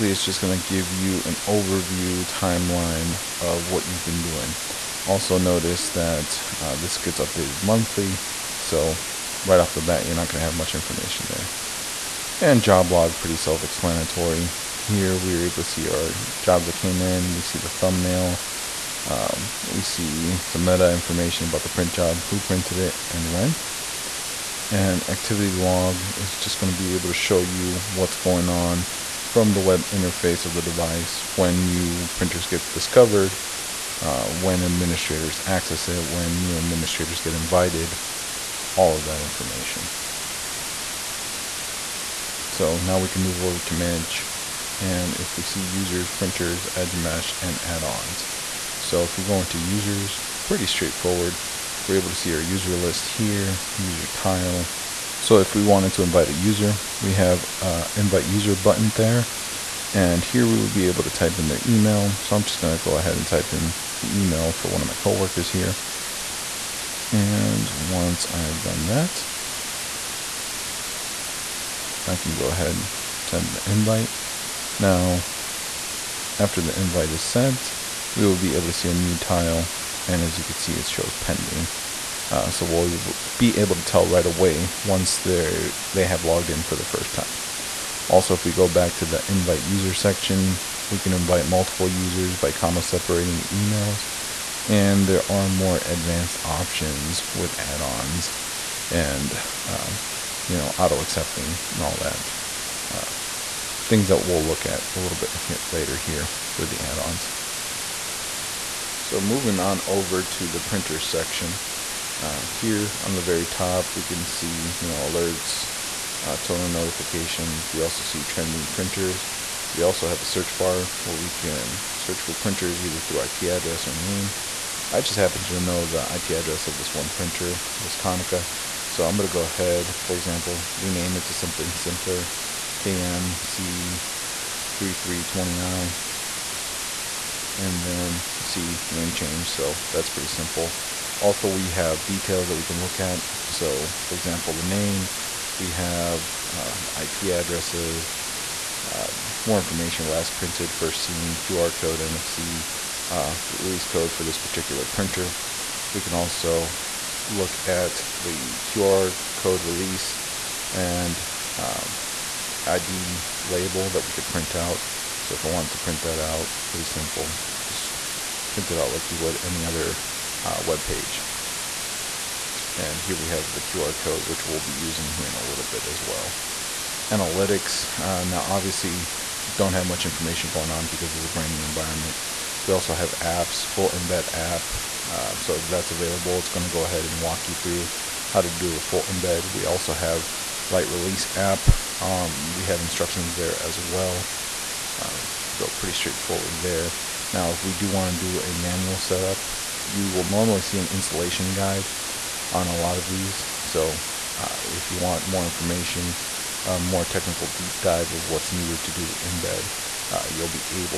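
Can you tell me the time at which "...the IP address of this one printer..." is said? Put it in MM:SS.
02:05.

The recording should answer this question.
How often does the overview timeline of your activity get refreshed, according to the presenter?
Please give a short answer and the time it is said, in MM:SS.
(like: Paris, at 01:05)
Monthly, at 00:07.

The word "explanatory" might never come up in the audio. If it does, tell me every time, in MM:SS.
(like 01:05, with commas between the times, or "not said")
00:13.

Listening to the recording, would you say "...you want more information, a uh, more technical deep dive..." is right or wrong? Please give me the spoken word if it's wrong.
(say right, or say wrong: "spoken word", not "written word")
right.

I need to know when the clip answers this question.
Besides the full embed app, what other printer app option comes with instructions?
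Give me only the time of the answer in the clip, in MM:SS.
03:10.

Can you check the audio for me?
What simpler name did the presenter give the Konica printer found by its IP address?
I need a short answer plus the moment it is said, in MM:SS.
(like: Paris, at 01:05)
KMC3320i, at 02:12.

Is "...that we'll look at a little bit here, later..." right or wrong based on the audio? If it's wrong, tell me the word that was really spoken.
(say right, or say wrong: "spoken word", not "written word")
right.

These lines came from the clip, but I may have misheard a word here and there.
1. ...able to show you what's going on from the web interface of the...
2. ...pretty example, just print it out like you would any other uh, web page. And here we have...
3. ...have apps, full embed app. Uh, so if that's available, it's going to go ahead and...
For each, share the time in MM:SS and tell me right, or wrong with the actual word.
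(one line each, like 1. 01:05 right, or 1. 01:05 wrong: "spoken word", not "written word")
1. 00:26 right
2. 02:46 wrong: "simple", not "example"
3. 03:02 right.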